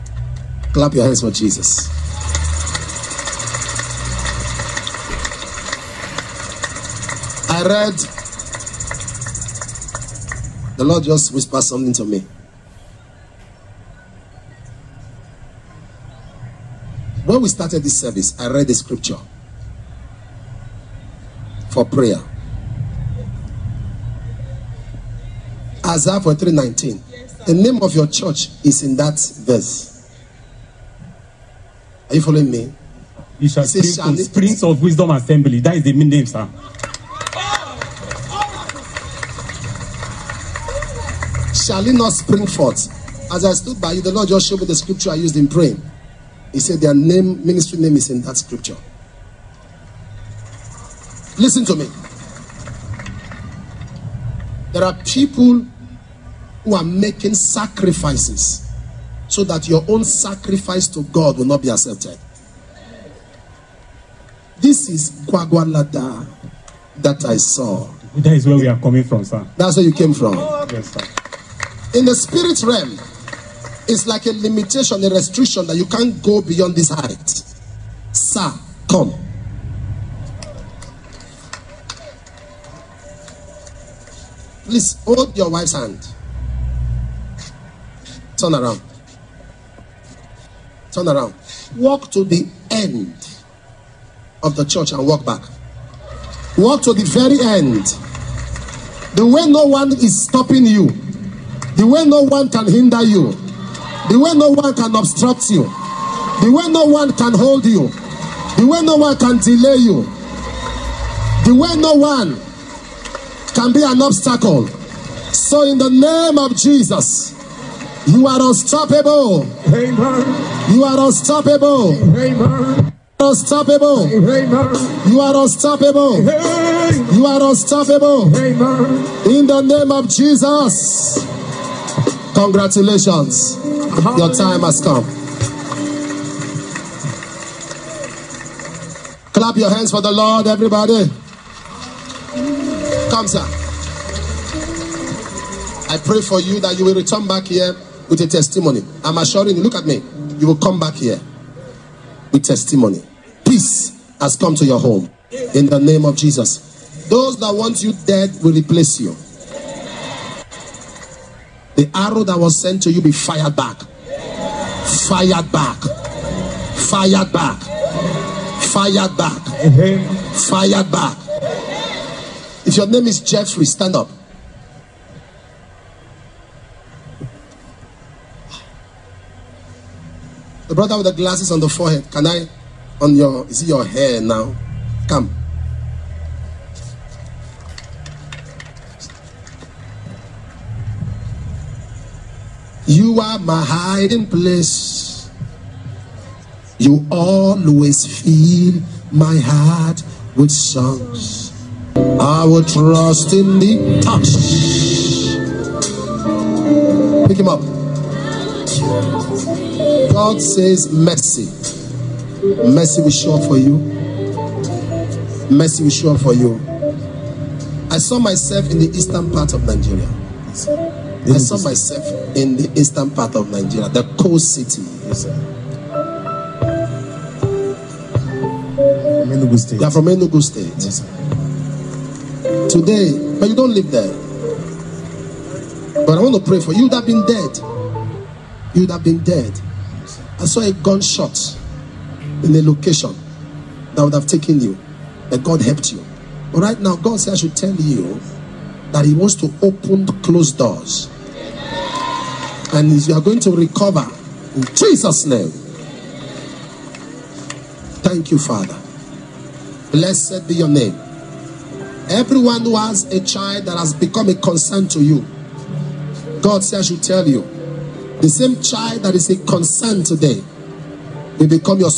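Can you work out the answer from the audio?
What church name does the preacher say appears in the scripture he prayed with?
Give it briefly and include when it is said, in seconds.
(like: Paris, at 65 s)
Springs of Wisdom Assembly, at 34 s.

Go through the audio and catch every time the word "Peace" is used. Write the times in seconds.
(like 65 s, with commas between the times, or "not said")
153 s.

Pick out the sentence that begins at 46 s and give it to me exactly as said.
He said their name, ministry name is in that scripture.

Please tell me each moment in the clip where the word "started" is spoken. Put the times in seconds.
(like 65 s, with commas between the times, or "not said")
17 s.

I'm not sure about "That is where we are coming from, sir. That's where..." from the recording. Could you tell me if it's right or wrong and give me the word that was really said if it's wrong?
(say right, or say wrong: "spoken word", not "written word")
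right.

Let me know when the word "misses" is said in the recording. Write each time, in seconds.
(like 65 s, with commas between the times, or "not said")
not said.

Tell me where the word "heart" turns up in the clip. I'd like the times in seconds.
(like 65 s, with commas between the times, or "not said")
199 s.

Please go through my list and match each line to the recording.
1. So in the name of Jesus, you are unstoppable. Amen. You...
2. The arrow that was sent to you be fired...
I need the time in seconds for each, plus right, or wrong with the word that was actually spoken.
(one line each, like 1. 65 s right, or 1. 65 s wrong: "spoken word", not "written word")
1. 115 s right
2. 161 s right.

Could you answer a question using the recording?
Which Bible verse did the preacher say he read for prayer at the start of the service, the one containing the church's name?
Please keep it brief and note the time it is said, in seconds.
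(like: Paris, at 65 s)
Isaiah 43:19, at 25 s.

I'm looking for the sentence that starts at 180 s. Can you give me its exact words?
The brother with the glasses on the forehead, can I?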